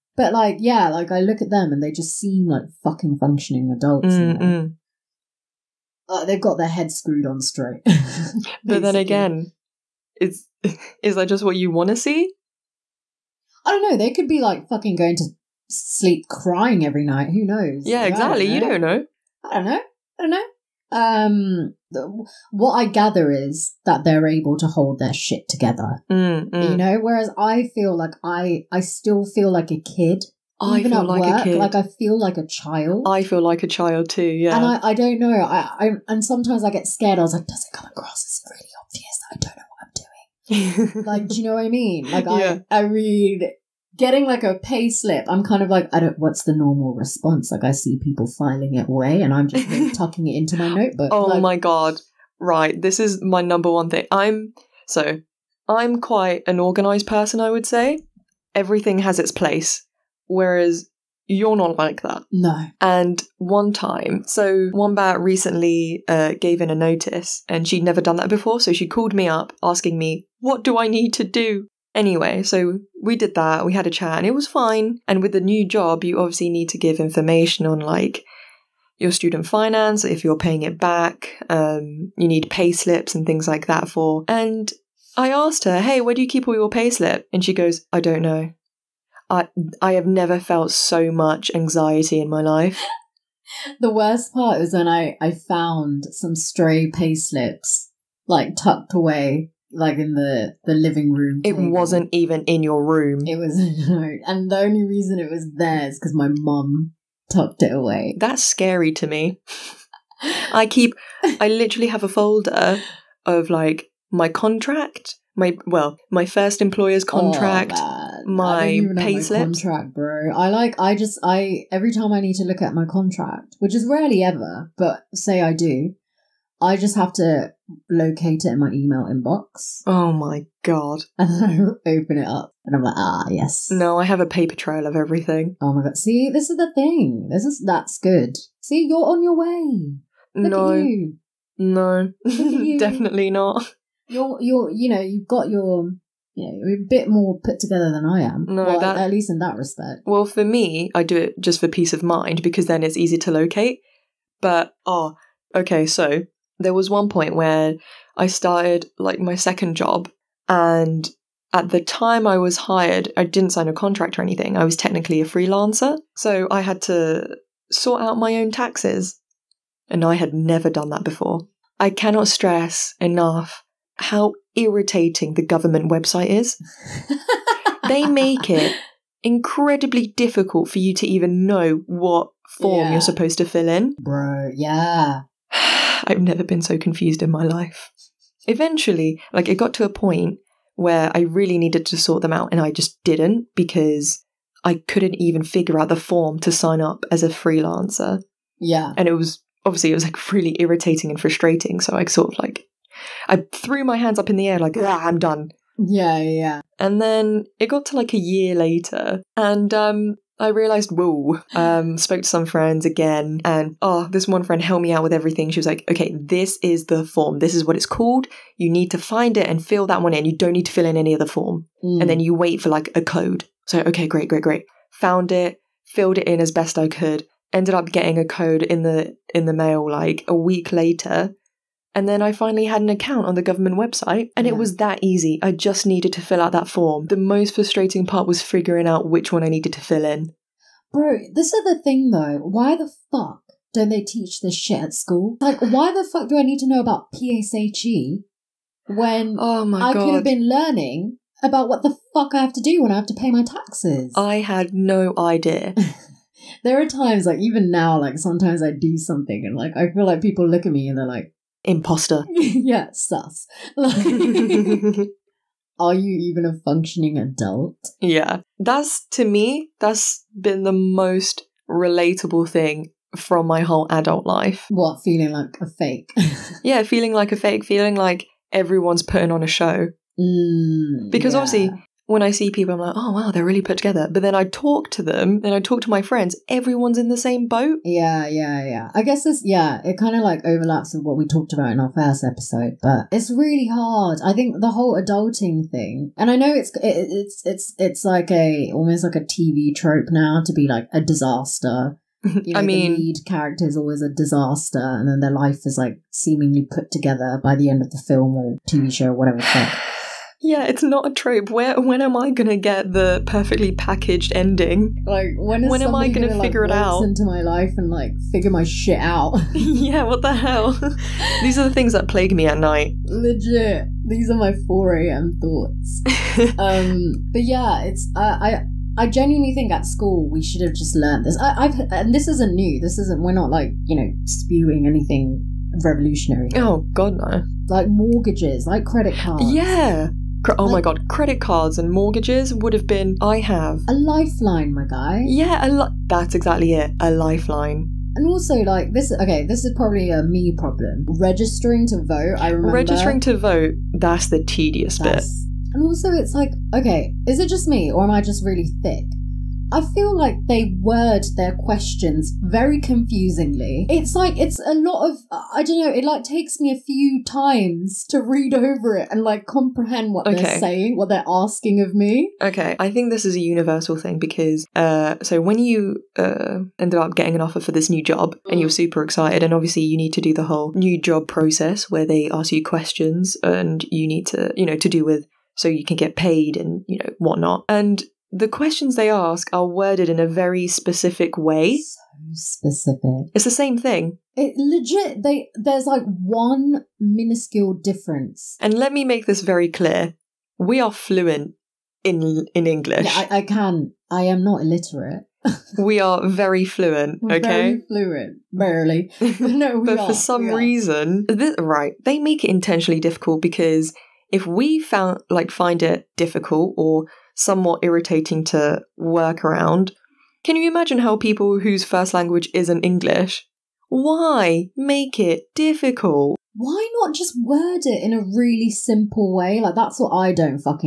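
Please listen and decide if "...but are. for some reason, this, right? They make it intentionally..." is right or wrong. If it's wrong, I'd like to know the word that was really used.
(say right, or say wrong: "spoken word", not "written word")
right.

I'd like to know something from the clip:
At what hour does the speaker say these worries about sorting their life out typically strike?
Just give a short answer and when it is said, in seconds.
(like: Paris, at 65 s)
4 a.m., at 324 s.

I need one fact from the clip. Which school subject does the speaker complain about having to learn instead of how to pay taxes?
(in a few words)
PSHE.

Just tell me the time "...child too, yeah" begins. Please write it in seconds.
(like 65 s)
33 s.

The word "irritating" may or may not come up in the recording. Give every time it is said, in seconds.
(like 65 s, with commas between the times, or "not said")
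174 s, 200 s, 417 s.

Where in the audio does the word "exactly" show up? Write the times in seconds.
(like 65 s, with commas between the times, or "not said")
18 s, 346 s.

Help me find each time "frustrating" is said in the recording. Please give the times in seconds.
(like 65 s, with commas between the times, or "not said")
201 s, 237 s.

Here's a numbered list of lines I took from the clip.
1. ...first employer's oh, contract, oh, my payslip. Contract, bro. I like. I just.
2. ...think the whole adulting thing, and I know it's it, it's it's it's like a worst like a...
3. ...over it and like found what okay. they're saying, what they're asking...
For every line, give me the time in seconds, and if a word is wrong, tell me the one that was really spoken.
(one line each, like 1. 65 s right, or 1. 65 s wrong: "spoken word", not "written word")
1. 116 s right
2. 294 s wrong: "almost", not "worst"
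3. 368 s wrong: "comprehend", not "found".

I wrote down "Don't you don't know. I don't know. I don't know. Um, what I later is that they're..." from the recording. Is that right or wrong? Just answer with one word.
wrong.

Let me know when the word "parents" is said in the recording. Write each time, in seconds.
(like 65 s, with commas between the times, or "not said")
not said.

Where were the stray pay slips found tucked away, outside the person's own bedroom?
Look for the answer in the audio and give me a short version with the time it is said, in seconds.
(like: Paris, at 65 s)
the living room, at 100 s.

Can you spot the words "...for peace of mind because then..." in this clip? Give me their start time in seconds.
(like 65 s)
151 s.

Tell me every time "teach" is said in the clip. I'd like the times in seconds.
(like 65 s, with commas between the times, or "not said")
244 s.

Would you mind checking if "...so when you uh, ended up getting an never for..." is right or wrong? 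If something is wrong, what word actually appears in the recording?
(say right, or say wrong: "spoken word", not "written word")
wrong: "offer", not "never".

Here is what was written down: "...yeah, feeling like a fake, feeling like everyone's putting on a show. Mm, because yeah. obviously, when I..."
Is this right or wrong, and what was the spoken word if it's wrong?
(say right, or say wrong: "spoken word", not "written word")
right.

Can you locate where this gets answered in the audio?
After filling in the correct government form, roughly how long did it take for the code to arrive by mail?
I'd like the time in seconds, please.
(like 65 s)
230 s.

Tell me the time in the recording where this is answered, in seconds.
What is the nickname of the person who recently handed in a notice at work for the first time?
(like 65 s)
64 s.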